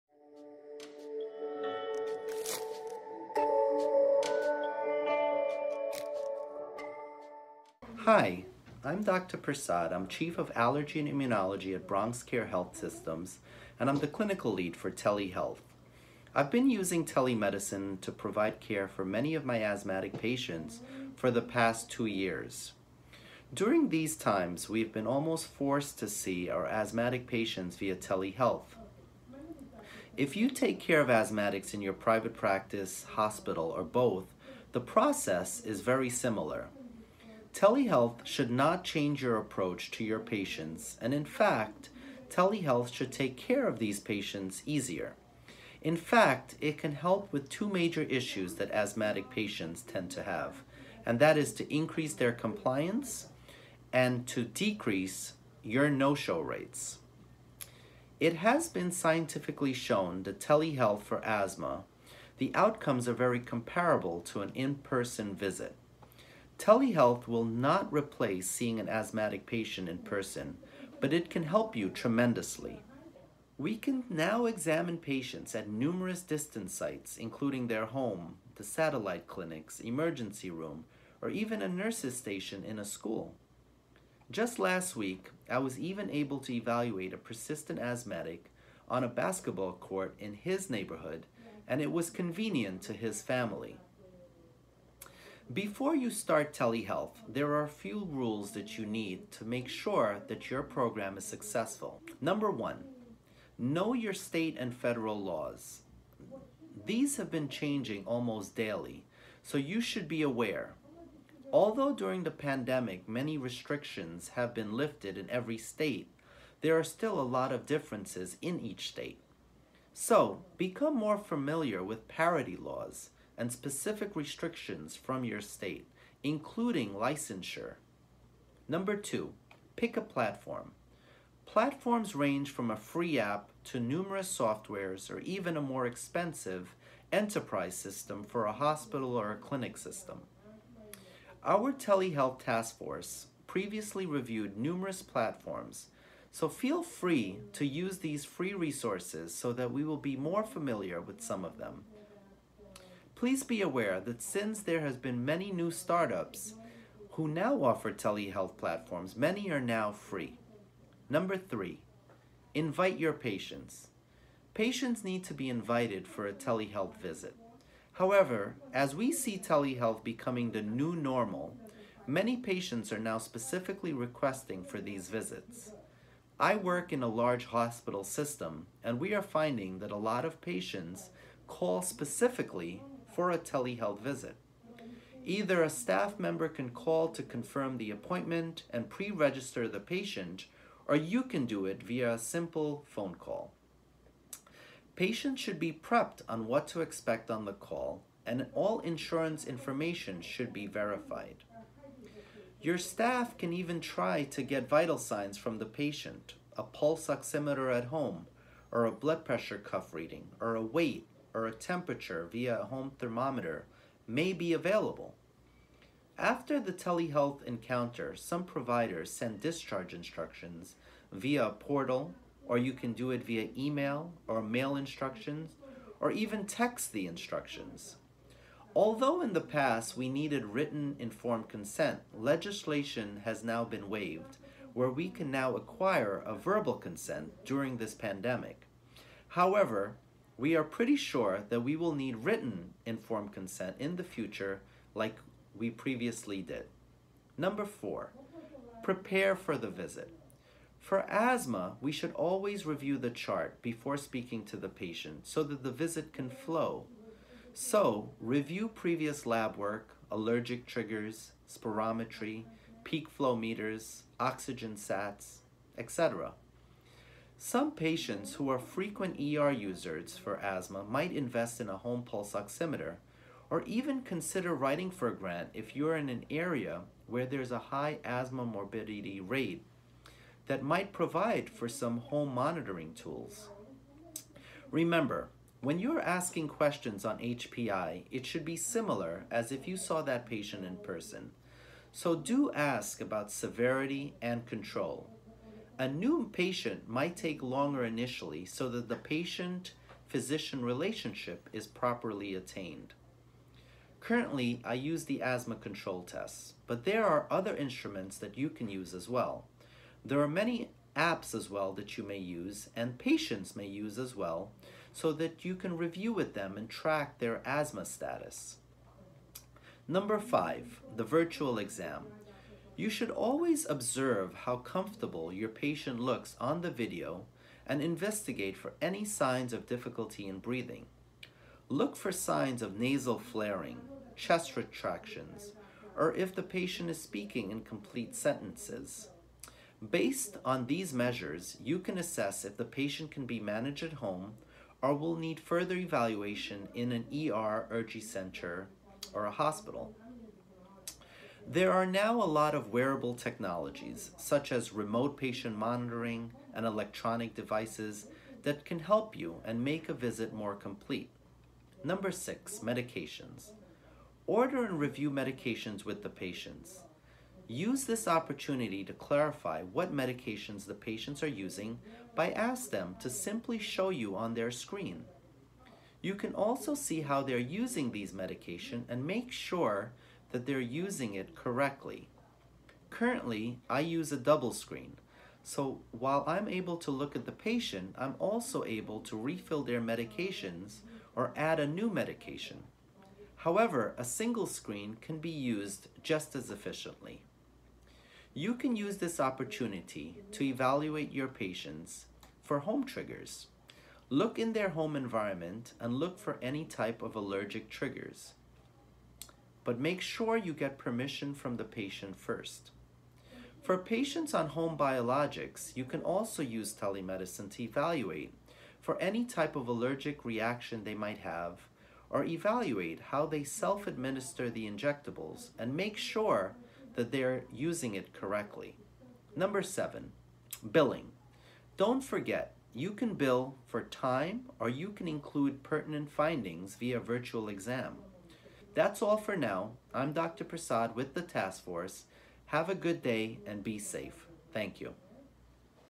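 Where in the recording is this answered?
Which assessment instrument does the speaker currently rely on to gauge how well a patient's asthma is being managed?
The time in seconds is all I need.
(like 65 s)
305 s.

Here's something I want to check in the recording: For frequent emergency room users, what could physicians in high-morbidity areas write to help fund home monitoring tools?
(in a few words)
a grant.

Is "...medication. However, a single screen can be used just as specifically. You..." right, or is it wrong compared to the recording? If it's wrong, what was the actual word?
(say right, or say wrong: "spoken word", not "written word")
wrong: "efficiently", not "specifically".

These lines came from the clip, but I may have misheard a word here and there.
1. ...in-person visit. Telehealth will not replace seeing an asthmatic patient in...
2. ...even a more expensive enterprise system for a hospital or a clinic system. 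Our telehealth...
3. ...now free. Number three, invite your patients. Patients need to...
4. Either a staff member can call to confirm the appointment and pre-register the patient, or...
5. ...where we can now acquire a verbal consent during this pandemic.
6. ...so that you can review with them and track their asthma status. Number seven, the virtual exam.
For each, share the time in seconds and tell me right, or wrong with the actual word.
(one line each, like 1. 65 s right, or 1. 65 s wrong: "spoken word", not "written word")
1. 64 s right
2. 135 s right
3. 159 s right
4. 185 s right
5. 234 s right
6. 314 s wrong: "five", not "seven".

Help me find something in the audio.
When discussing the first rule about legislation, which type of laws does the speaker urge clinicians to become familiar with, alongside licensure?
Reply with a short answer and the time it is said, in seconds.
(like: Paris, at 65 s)
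parity laws, at 122 s.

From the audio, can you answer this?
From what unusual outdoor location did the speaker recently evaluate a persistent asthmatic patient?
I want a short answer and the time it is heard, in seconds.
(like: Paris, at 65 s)
basketball court, at 89 s.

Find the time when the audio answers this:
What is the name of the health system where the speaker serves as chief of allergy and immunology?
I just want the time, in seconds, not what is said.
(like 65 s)
11 s.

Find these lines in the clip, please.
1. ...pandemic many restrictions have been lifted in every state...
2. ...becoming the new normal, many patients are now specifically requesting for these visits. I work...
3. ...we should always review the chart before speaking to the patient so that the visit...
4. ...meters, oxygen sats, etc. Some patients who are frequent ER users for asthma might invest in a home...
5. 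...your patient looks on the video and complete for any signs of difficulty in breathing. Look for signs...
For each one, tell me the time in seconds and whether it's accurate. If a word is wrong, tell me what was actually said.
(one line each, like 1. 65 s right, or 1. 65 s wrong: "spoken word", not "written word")
1. 112 s right
2. 170 s right
3. 251 s right
4. 263 s right
5. 325 s wrong: "investigate", not "complete".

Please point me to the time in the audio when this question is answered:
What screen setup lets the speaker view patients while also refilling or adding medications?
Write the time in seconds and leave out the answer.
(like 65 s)
384 s.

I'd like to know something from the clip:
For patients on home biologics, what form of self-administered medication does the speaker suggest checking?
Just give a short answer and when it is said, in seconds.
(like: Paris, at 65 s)
injectables, at 424 s.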